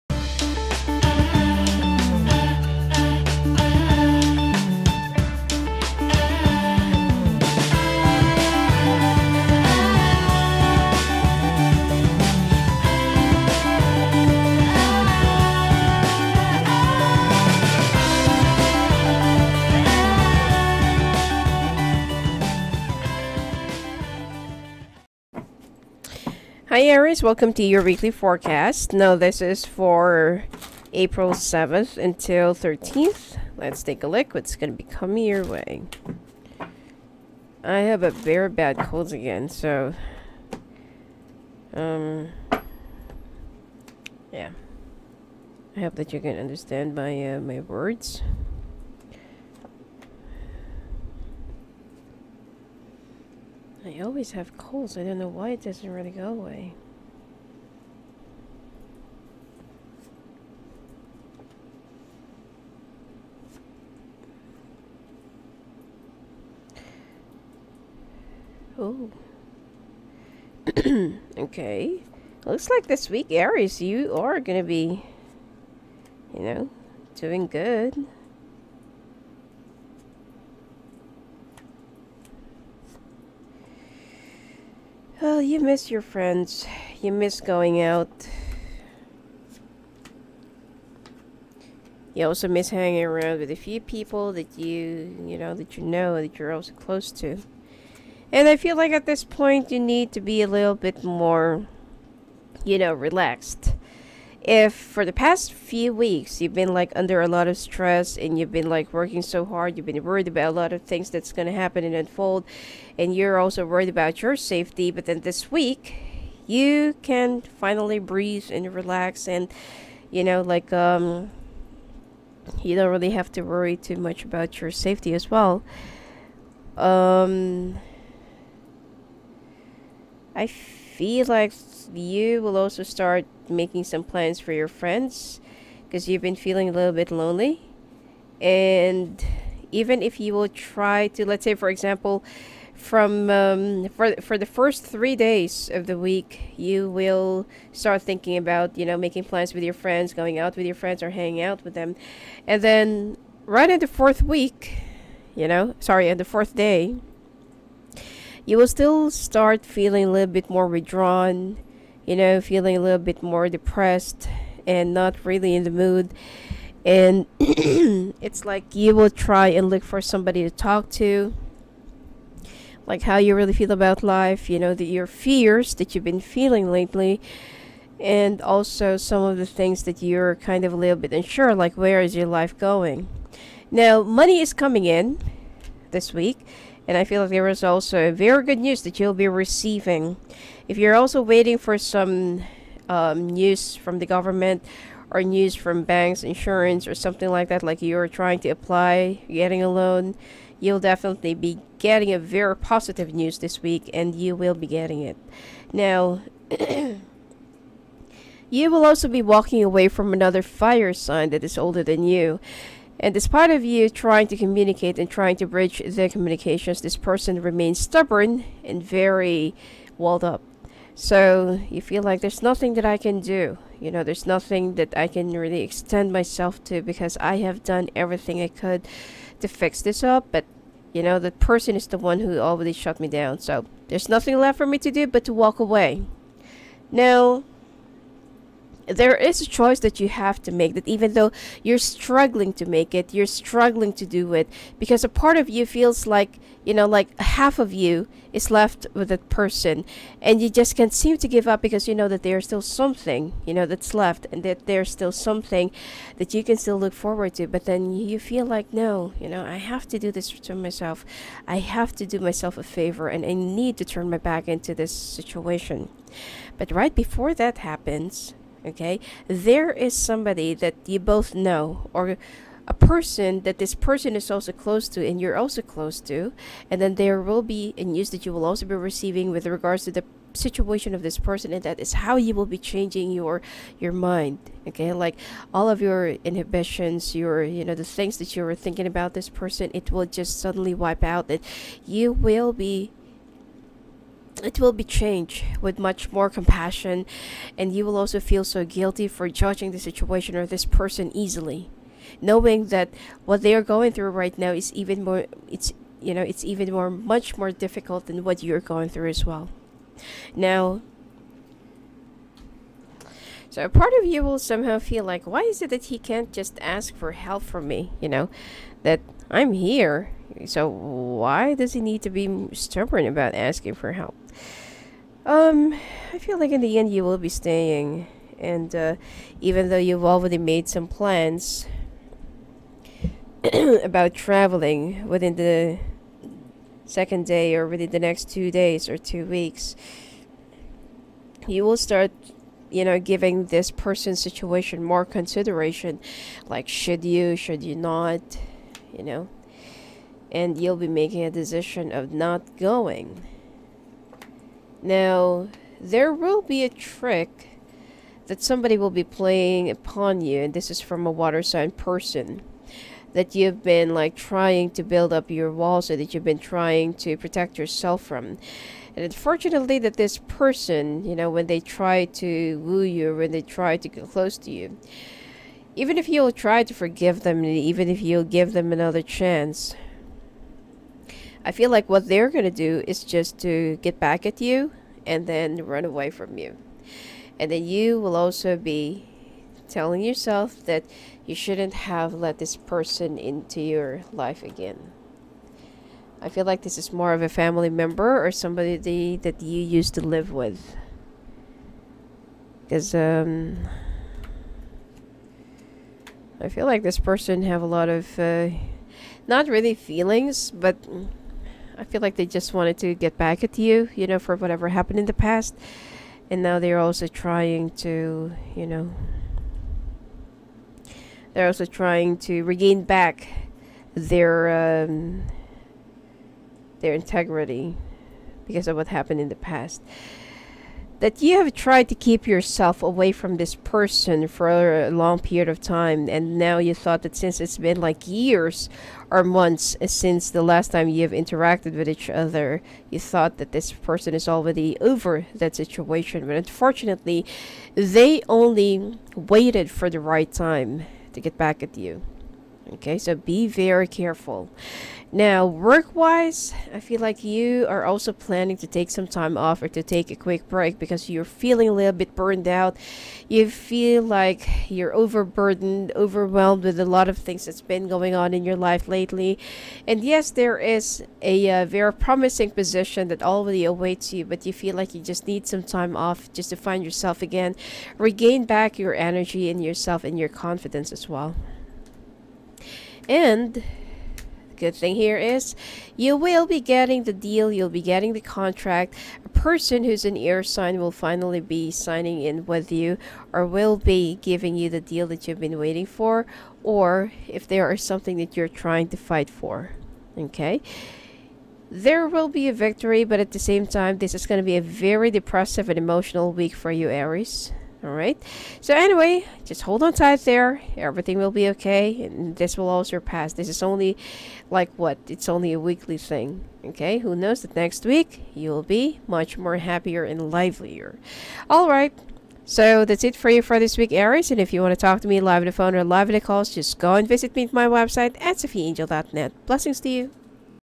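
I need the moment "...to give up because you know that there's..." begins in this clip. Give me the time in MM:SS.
04:11.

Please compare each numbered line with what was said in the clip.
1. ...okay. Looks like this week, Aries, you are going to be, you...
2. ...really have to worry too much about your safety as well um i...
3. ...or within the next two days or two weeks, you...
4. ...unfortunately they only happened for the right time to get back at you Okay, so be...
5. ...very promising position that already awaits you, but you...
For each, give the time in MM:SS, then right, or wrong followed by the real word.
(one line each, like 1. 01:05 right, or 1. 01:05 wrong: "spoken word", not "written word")
1. 01:11 right
2. 02:02 right
3. 05:37 right
4. 07:26 wrong: "waited", not "happened"
5. 07:51 right.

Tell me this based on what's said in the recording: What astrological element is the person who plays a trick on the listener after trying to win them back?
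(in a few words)
Water sign.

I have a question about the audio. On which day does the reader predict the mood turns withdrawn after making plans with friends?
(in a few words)
Fourth day.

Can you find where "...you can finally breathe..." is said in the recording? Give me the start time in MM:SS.
01:56.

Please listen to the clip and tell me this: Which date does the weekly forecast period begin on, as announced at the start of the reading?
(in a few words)
April 7th.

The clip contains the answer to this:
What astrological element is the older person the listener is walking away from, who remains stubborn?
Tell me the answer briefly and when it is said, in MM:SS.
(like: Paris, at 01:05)
Fire sign, at 03:30.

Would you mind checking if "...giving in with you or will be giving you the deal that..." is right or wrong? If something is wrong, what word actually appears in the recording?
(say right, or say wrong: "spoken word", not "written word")
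wrong: "signing", not "giving".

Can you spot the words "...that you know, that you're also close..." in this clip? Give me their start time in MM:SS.
01:35.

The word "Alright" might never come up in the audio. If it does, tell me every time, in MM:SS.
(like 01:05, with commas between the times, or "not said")
08:27, 08:41.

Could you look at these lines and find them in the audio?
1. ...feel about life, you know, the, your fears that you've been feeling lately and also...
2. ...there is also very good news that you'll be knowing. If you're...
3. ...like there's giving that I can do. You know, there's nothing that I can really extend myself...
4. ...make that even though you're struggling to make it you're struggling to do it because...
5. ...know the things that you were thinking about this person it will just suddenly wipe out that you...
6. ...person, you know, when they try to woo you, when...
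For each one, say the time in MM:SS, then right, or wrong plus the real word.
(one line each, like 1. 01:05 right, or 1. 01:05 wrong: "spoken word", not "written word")
1. 02:53 right
2. 03:07 wrong: "receiving", not "knowing"
3. 03:42 wrong: "nothing", not "giving"
4. 04:00 right
5. 04:47 right
6. 06:10 right.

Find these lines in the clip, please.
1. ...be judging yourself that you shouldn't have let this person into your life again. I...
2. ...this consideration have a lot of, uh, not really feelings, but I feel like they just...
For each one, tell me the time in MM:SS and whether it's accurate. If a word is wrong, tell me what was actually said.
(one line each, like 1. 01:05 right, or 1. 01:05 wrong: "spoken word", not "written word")
1. 06:28 wrong: "telling", not "judging"
2. 06:46 wrong: "person", not "consideration".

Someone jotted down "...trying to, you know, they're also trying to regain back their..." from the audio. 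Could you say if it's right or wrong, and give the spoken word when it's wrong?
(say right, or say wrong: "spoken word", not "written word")
right.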